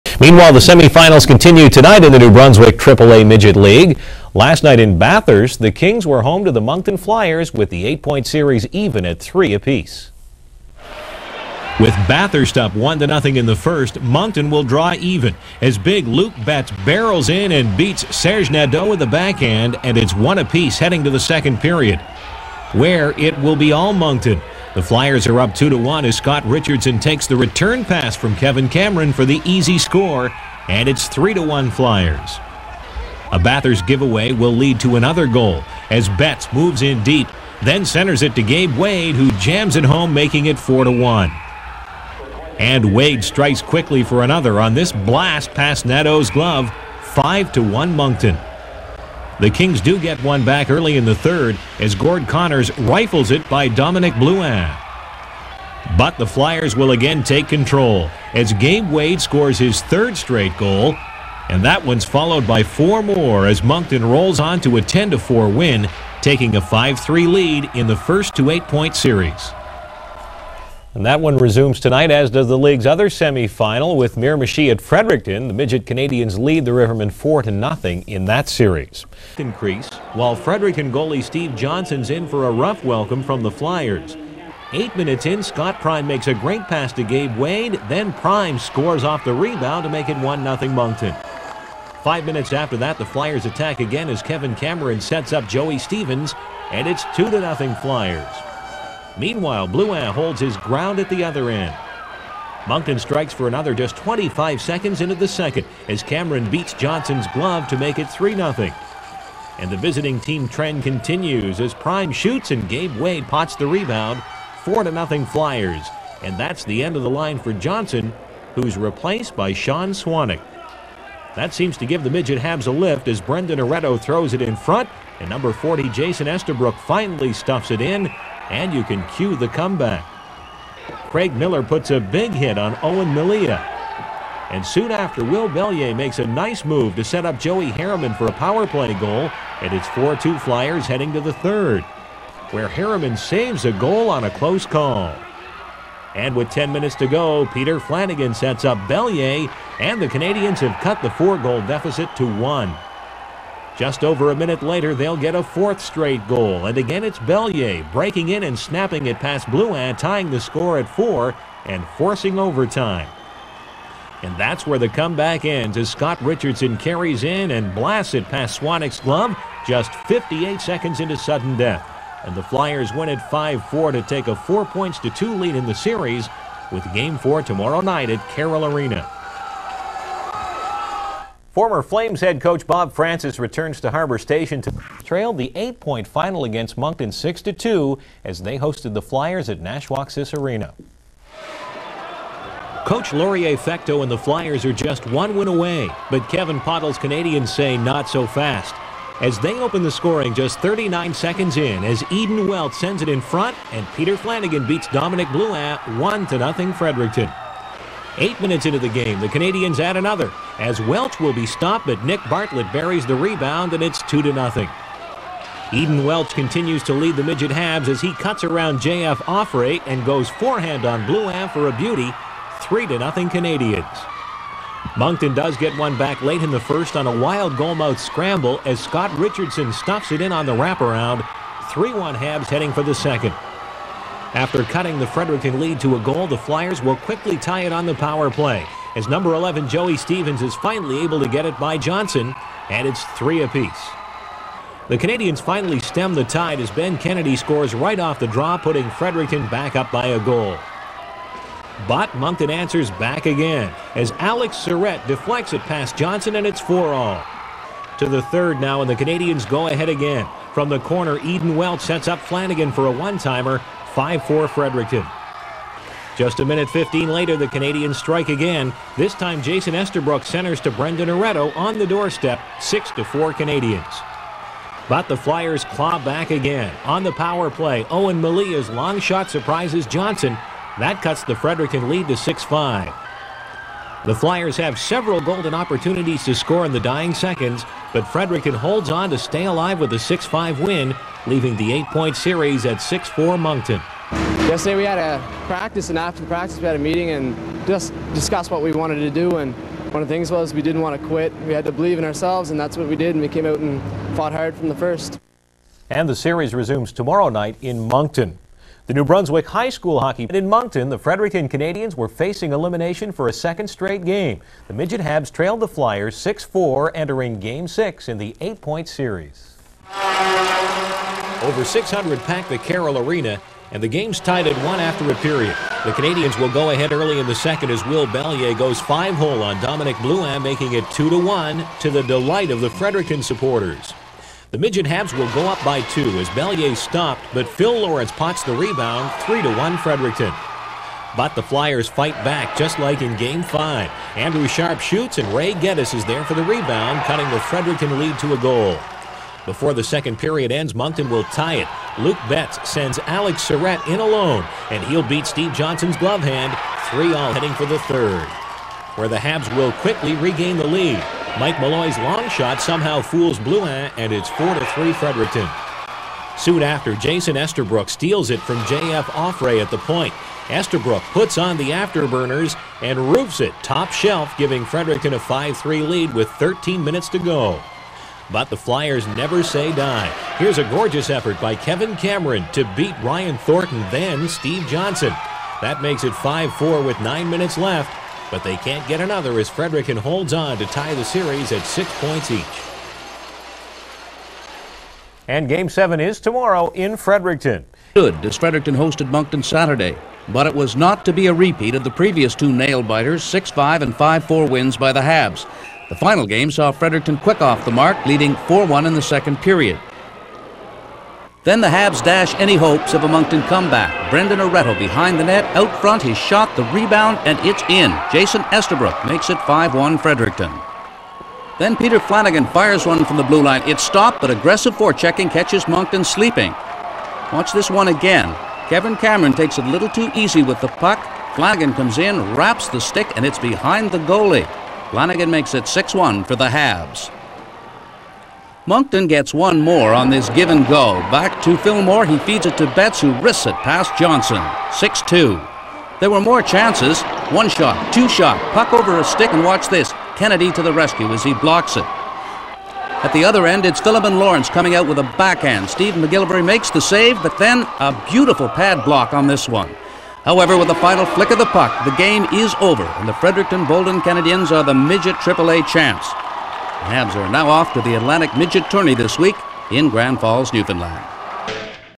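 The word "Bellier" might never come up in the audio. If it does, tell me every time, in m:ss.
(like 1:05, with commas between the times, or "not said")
2:15, 2:28, 2:37, 5:28, 5:36.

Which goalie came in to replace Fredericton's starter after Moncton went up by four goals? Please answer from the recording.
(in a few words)
Sean Swanick.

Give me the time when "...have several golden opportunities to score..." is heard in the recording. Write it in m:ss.
4:44.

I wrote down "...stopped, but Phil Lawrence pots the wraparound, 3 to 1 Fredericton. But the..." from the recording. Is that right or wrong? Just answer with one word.
wrong.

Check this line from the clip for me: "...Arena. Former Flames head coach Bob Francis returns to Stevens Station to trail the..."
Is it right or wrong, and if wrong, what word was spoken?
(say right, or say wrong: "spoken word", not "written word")
wrong: "Harbor", not "Stevens".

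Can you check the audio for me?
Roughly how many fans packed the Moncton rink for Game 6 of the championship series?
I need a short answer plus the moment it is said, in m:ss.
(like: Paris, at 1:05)
600, at 5:21.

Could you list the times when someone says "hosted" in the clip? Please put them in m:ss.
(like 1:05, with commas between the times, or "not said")
3:08, 6:38.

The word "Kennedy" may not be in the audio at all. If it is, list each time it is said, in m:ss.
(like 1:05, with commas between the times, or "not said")
4:06, 7:30.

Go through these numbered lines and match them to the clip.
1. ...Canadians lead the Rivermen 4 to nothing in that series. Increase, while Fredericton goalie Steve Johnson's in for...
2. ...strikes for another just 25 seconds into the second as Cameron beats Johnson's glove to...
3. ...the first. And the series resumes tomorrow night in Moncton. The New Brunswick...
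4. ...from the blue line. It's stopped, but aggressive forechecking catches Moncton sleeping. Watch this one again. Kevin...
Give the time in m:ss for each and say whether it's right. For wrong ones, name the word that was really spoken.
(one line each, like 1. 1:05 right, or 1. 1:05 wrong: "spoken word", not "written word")
1. 1:15 right
2. 1:42 right
3. 5:04 right
4. 7:03 right.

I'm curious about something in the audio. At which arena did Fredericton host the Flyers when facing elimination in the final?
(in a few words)
Nashwaaksis Arena.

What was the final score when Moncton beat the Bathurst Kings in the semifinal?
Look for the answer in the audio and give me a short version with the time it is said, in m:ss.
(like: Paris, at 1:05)
10-4, at 1:04.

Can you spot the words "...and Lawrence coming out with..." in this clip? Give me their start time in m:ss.
7:34.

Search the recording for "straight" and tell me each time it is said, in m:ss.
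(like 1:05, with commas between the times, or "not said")
1:00, 2:35, 5:13.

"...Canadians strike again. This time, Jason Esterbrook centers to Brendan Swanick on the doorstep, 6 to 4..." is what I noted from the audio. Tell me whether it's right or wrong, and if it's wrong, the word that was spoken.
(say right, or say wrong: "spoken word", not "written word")
wrong: "Aretto", not "Swanick".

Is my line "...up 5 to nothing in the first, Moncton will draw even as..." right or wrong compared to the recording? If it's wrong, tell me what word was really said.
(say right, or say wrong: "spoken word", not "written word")
wrong: "1", not "5".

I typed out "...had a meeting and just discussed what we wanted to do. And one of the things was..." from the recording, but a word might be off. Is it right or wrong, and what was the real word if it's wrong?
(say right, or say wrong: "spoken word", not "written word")
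right.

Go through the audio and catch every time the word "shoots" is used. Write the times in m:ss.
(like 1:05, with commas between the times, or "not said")
1:52, 5:44.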